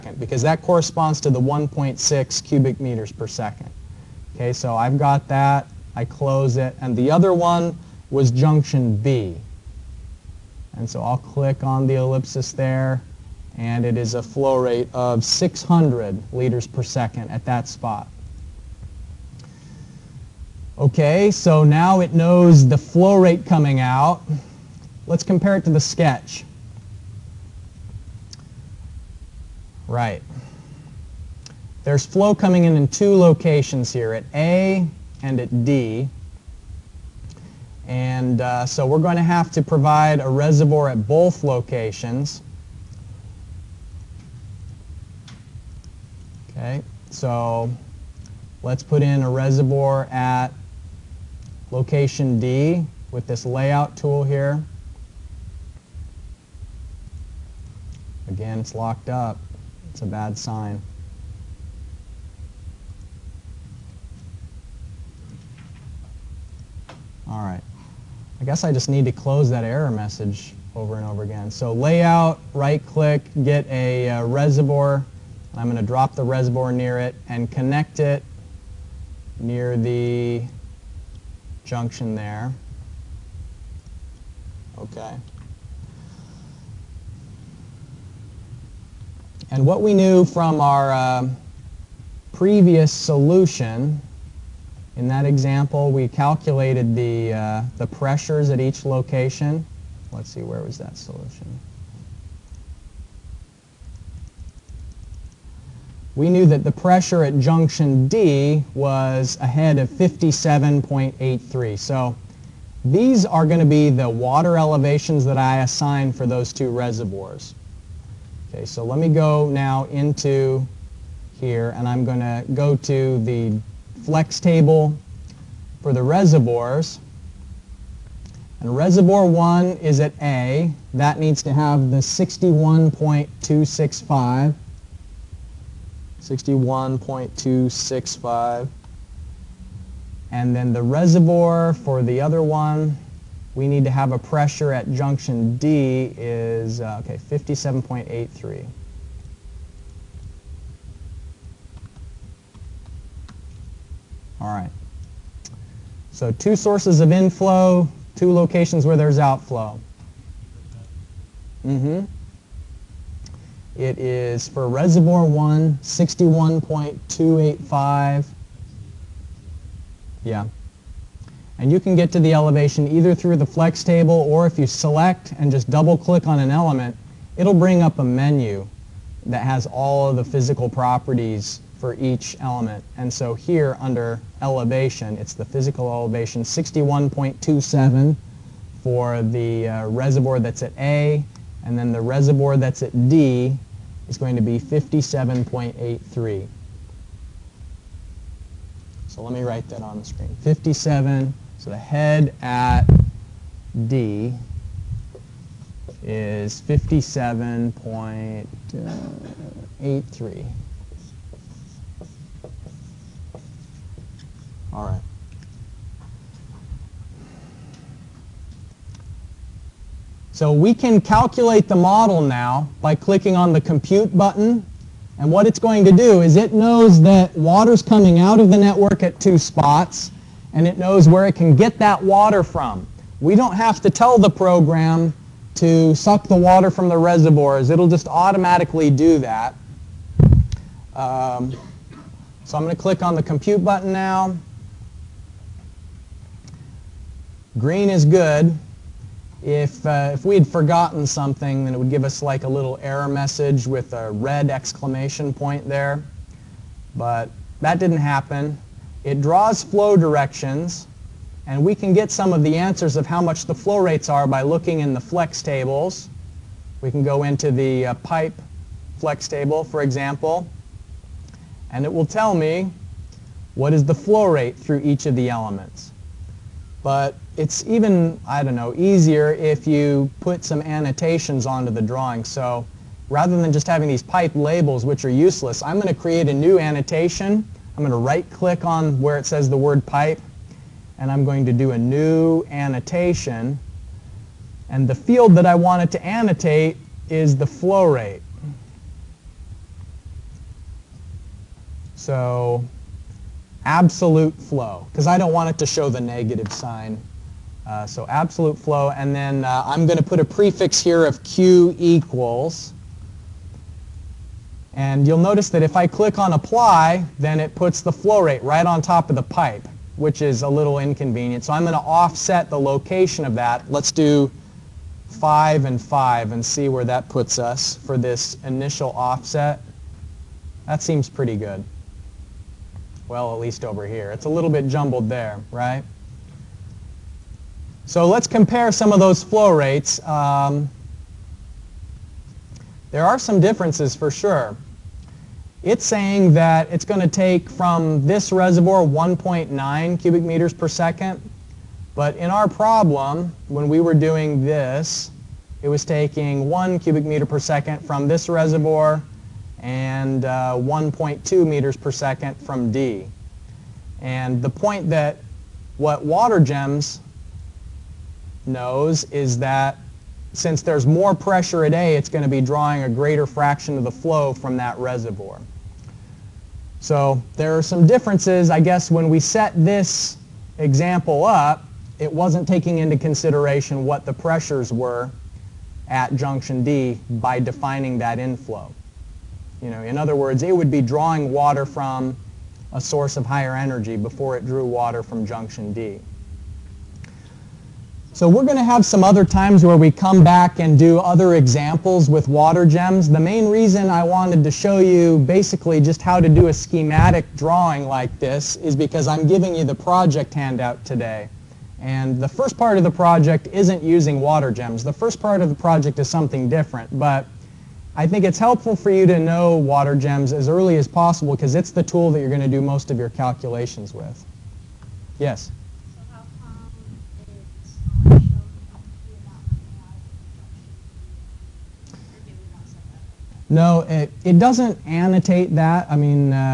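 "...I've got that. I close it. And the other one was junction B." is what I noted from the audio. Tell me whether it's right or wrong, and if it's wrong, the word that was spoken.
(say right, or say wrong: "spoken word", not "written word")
right.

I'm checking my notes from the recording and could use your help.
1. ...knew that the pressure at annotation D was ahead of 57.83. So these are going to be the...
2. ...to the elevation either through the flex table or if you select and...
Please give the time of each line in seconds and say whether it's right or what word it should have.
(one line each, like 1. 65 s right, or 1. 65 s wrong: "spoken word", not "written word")
1. 106 s wrong: "junction", not "annotation"
2. 172 s right.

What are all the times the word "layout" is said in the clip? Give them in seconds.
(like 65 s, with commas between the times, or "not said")
53 s, 71 s.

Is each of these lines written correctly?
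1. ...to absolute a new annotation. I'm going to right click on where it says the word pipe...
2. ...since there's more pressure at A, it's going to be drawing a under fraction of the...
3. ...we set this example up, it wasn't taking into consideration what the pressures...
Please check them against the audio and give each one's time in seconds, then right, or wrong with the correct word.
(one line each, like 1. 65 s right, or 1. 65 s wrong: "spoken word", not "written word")
1. 285 s wrong: "create", not "absolute"
2. 370 s wrong: "greater", not "under"
3. 379 s right.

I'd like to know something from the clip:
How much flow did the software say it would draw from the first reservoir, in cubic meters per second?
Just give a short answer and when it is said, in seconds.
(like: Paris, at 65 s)
1.9, at 348 s.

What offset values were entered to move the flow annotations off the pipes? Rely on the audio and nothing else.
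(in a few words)
5 and 5.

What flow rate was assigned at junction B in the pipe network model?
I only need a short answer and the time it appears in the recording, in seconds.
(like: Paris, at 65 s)
600 liters per second, at 15 s.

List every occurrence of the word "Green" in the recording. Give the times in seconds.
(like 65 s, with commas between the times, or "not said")
247 s.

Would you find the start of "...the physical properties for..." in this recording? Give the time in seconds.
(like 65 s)
180 s.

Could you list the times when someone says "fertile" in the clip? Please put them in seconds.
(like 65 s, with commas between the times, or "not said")
not said.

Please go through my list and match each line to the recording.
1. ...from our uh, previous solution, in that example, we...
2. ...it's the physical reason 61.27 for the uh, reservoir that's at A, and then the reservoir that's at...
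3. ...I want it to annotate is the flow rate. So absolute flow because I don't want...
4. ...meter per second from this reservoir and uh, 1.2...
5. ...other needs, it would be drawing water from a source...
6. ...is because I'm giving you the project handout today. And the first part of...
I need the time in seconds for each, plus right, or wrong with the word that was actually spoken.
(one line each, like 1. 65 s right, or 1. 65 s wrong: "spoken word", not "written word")
1. 90 s right
2. 185 s wrong: "elevation", not "reason"
3. 295 s right
4. 357 s right
5. 389 s wrong: "words", not "needs"
6. 408 s right.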